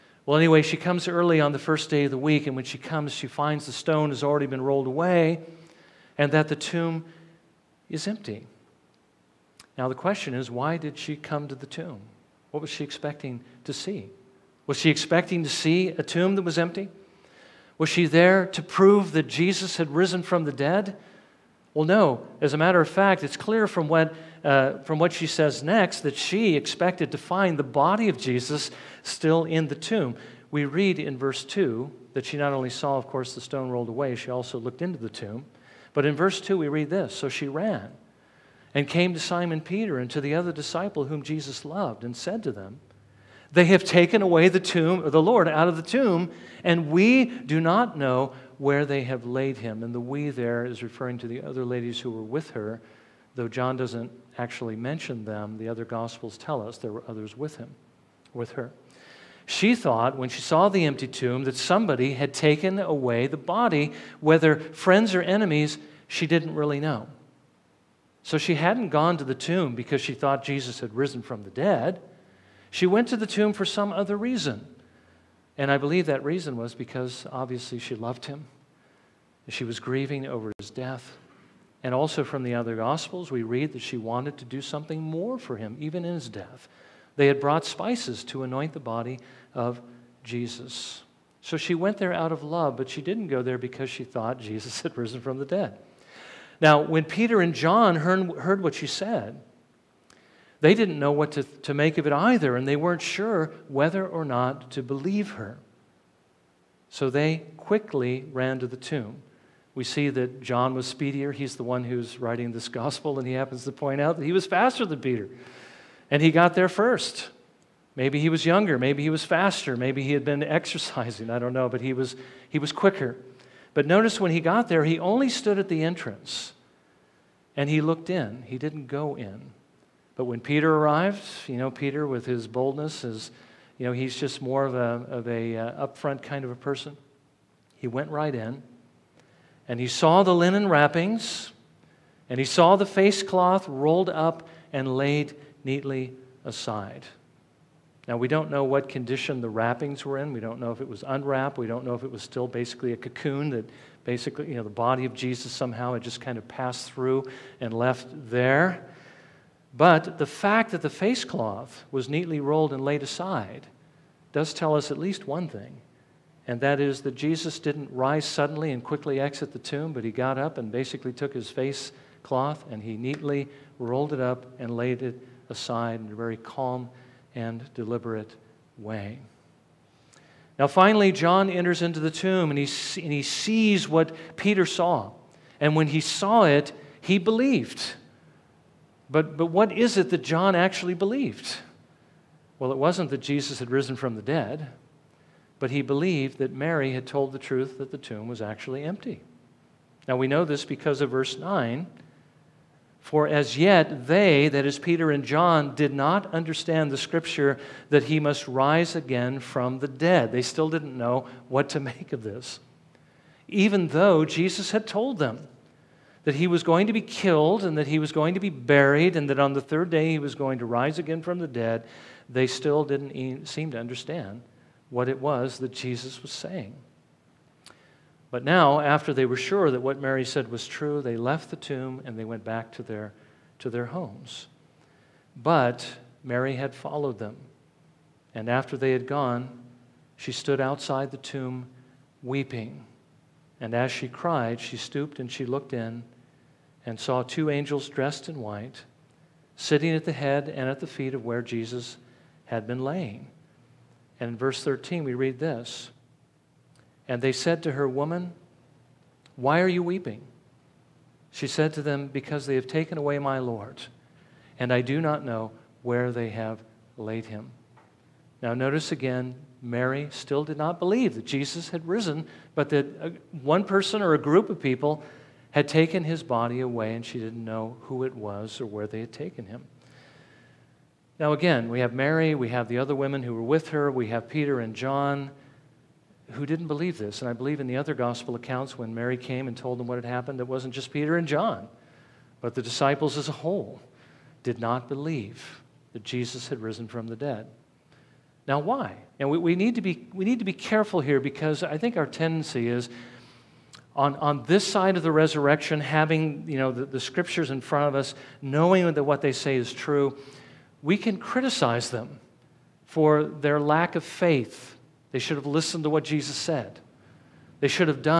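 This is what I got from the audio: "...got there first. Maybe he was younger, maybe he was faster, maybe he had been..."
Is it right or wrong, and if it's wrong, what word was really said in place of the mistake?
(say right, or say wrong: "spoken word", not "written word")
right.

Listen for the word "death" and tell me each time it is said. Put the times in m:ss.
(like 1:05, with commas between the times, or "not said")
1:20, 1:26.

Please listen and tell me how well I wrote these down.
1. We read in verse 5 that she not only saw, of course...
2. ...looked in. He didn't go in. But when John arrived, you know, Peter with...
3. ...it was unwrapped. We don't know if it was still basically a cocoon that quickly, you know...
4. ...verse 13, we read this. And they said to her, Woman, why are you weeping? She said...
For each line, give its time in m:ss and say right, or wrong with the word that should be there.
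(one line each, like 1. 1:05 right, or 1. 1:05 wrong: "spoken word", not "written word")
1. 0:30 wrong: "2", not "5"
2. 2:07 wrong: "Peter", not "John"
3. 2:30 wrong: "basically", not "quickly"
4. 4:14 right.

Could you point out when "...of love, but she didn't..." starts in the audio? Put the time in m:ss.
1:32.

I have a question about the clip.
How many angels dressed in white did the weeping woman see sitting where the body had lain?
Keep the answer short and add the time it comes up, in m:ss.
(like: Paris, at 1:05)
2, at 4:07.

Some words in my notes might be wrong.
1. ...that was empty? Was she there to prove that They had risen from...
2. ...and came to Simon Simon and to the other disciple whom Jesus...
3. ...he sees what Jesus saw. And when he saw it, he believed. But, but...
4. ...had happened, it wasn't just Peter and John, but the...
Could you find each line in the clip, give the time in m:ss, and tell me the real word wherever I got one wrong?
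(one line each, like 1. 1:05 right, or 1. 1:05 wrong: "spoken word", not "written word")
1. 0:16 wrong: "Jesus", not "They"
2. 0:38 wrong: "Peter", not "Simon"
3. 3:03 wrong: "Peter", not "Jesus"
4. 4:49 right.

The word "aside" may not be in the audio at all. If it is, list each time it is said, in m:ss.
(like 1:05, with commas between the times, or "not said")
2:26, 2:43, 2:55.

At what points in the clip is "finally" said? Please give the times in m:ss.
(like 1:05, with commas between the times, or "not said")
3:00.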